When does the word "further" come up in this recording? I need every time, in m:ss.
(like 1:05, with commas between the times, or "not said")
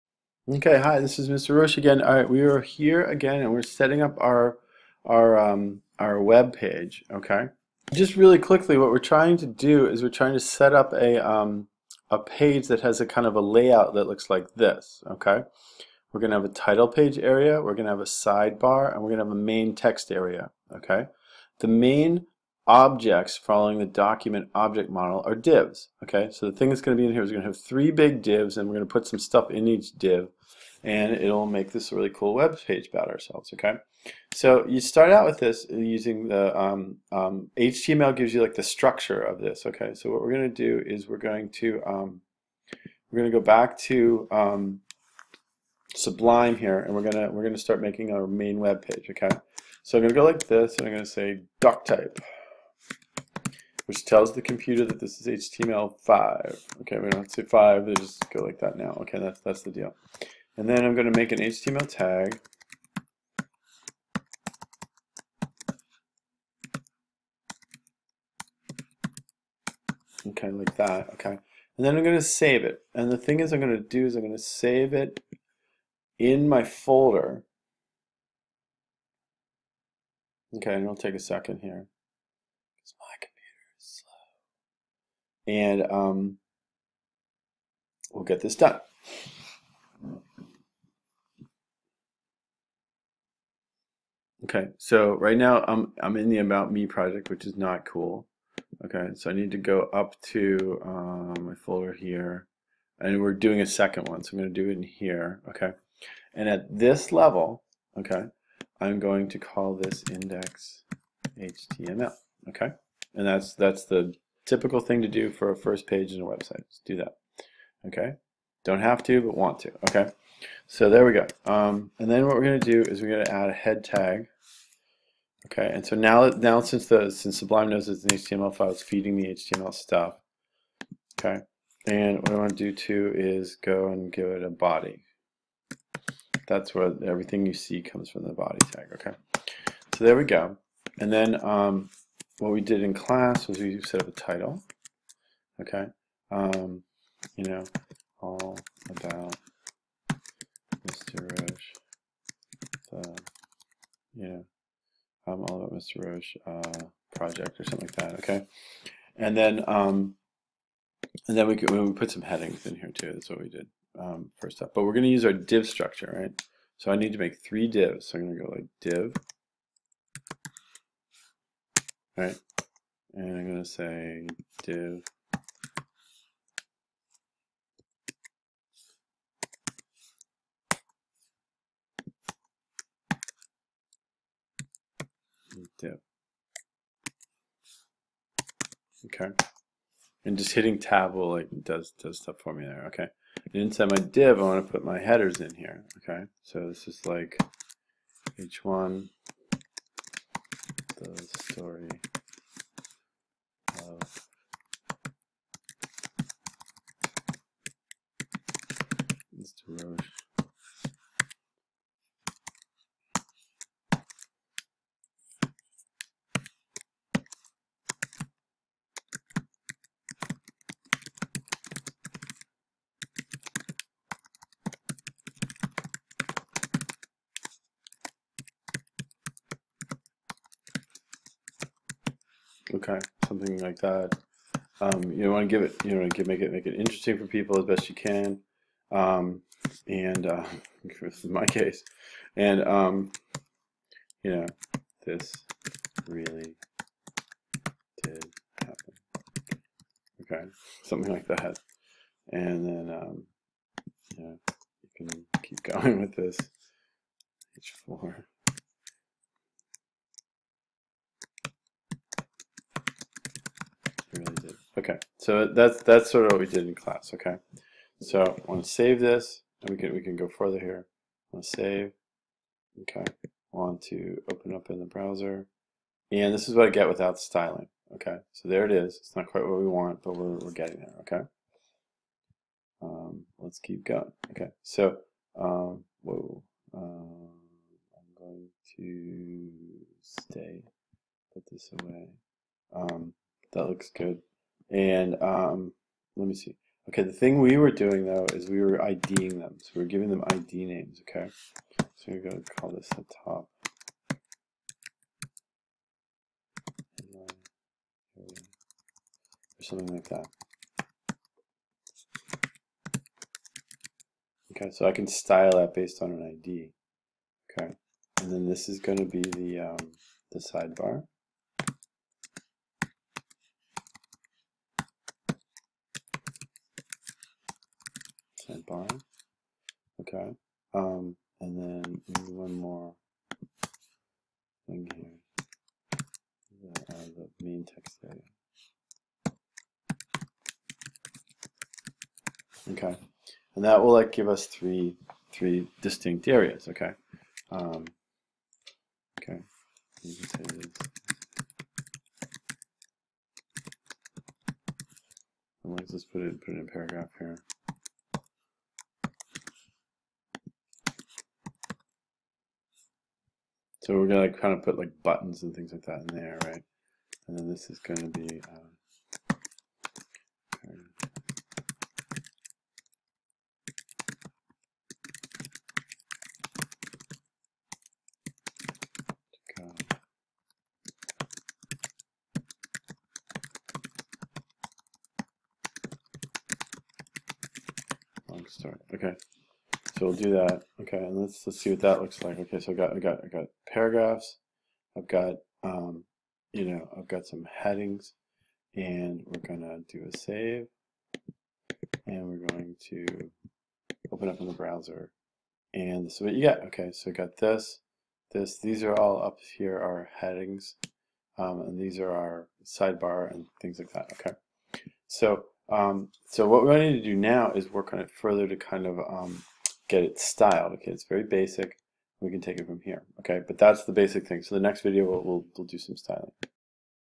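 4:30, 6:58.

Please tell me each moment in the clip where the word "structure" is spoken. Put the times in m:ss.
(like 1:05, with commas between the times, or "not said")
0:38, 2:45.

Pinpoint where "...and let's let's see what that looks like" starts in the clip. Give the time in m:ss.
6:30.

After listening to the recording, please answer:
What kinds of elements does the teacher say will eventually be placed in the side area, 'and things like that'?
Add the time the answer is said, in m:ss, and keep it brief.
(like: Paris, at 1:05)
buttons, at 6:05.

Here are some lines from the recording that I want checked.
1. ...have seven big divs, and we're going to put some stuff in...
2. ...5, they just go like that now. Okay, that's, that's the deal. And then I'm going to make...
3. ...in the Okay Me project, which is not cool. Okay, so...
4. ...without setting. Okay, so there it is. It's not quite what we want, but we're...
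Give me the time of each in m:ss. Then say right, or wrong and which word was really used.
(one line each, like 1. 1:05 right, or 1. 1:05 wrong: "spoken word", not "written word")
1. 0:27 wrong: "three", not "seven"
2. 0:57 right
3. 1:36 wrong: "About", not "Okay"
4. 4:36 wrong: "styling", not "setting".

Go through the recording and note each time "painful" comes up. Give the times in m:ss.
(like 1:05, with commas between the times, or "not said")
not said.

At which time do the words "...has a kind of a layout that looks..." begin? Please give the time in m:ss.
0:12.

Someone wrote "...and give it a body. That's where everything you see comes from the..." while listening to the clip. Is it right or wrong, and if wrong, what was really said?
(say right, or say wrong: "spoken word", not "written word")
right.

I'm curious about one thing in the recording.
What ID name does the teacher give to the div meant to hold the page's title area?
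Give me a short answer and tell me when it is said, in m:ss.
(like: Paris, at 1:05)
top, at 5:02.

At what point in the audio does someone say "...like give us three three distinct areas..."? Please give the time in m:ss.
5:43.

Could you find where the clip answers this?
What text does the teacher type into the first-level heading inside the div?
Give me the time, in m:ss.
3:18.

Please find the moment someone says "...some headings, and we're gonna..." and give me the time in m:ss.
6:37.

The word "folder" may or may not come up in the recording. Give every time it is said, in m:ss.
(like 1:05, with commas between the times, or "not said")
1:16, 1:41.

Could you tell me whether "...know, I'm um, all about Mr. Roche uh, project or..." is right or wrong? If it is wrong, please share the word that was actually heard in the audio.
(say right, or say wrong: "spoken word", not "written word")
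right.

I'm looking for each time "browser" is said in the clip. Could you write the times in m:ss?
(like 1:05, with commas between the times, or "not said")
4:34, 6:44.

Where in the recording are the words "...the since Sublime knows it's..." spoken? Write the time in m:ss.
2:06.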